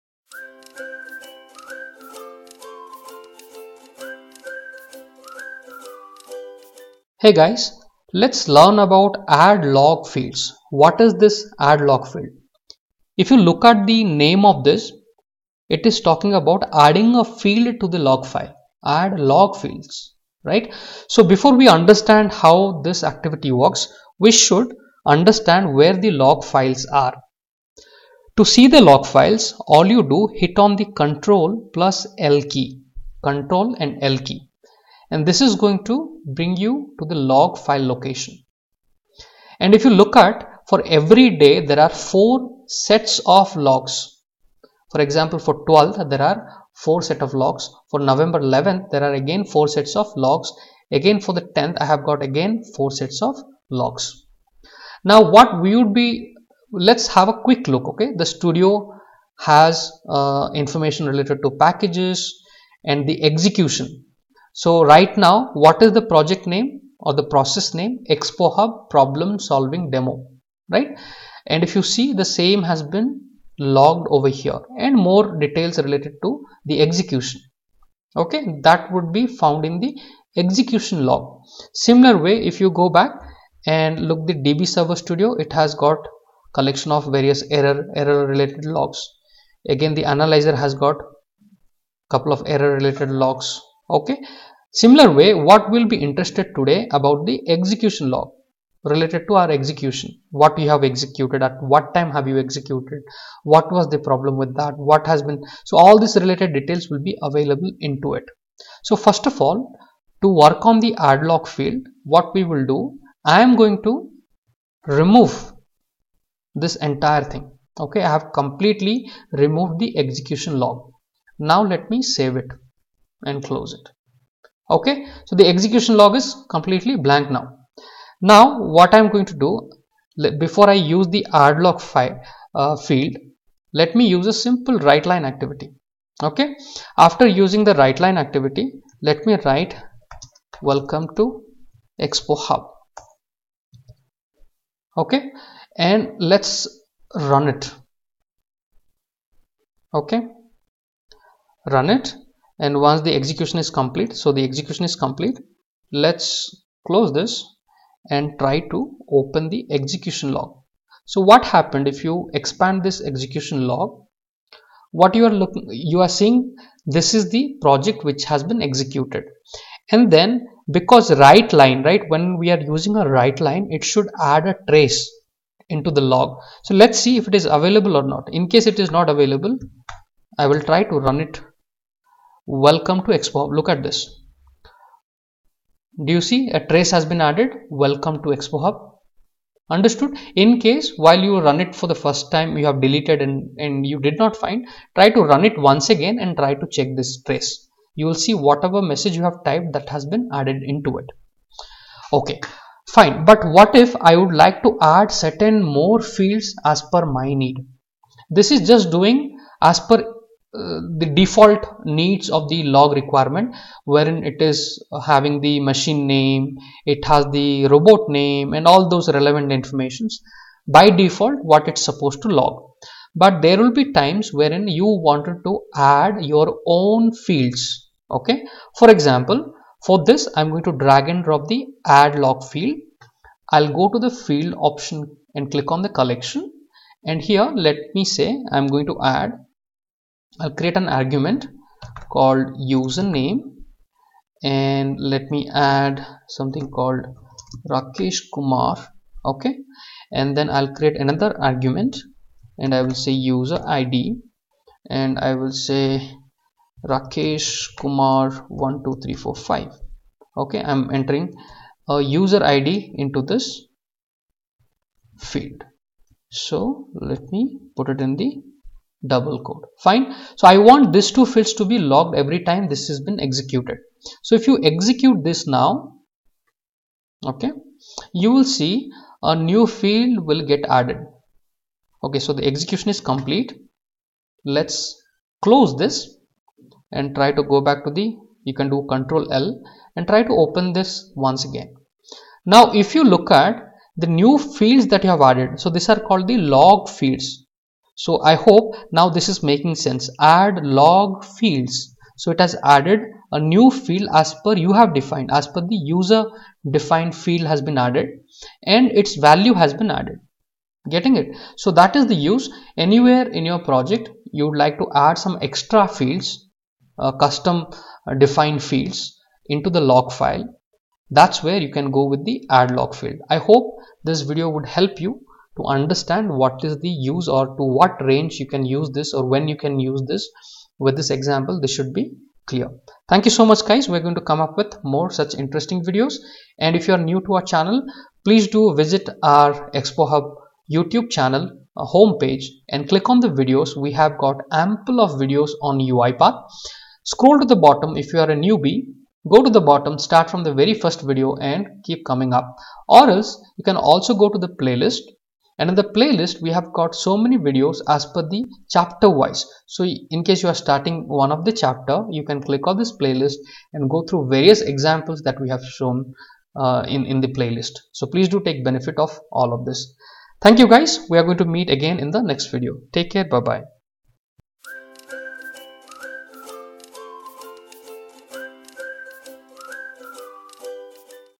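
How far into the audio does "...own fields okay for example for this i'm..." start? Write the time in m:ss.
3:46.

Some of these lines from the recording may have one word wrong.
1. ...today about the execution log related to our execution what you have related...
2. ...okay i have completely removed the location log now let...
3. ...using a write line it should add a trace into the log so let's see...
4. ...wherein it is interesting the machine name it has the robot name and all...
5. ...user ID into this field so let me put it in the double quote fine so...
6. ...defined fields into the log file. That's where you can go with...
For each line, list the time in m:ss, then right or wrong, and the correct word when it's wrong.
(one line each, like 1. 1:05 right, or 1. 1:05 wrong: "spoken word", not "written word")
1. 1:36 wrong: "executed", not "related"
2. 1:57 wrong: "execution", not "location"
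3. 2:52 right
4. 3:33 wrong: "having", not "interesting"
5. 4:21 right
6. 5:18 right.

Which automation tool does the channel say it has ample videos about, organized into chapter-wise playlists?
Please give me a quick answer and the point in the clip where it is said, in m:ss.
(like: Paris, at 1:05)
UiPath, at 5:45.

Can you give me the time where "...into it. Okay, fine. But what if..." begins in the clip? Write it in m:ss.
3:20.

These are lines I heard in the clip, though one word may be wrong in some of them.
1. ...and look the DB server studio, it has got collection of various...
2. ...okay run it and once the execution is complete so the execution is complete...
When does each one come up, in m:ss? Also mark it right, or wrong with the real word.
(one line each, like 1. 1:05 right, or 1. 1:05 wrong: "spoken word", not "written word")
1. 1:23 right
2. 2:30 right.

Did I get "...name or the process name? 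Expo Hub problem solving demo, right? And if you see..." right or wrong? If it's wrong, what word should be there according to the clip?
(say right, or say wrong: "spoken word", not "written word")
right.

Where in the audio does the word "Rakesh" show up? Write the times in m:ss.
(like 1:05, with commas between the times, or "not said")
4:07, 4:16.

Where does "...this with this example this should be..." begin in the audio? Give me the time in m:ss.
5:30.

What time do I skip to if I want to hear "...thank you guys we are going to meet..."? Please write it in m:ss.
6:10.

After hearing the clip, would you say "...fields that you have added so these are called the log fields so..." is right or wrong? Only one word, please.
right.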